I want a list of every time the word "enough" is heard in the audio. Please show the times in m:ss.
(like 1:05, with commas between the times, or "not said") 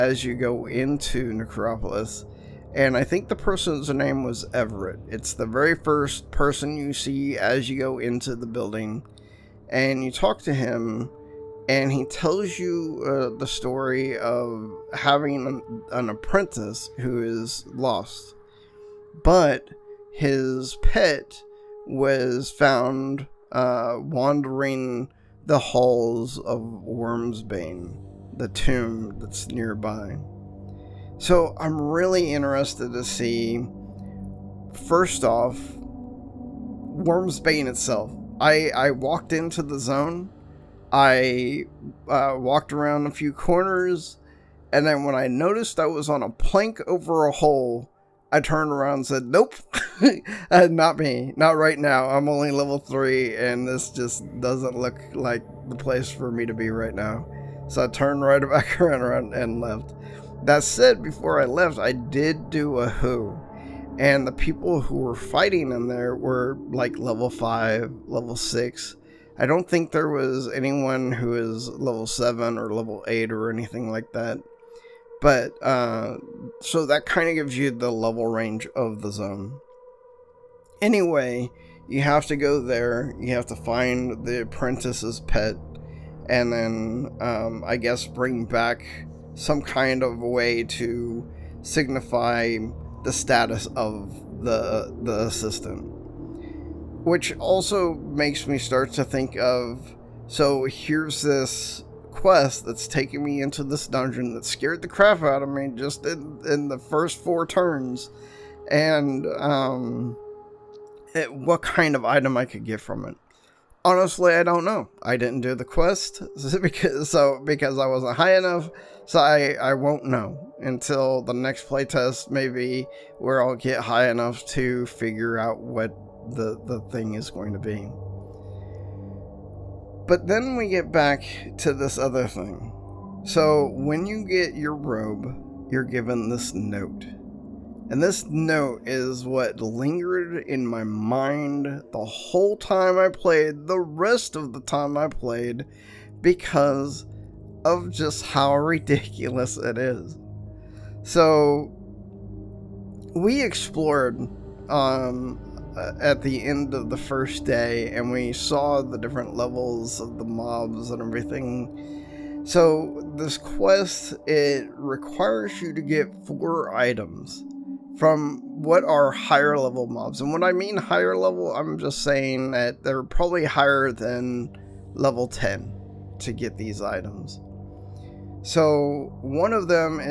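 1:58, 2:04.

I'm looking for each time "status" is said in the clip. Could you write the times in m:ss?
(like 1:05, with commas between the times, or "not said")
1:33.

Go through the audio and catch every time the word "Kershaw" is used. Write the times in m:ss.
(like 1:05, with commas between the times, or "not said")
not said.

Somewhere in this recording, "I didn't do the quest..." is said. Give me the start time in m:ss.
1:55.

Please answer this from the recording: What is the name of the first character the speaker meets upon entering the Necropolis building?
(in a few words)
Everett.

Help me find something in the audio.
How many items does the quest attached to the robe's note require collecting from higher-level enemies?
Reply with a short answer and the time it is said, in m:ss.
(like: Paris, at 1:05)
4, at 2:46.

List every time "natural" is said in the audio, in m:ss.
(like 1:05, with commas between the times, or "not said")
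not said.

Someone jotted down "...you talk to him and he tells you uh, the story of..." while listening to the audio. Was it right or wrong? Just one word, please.
right.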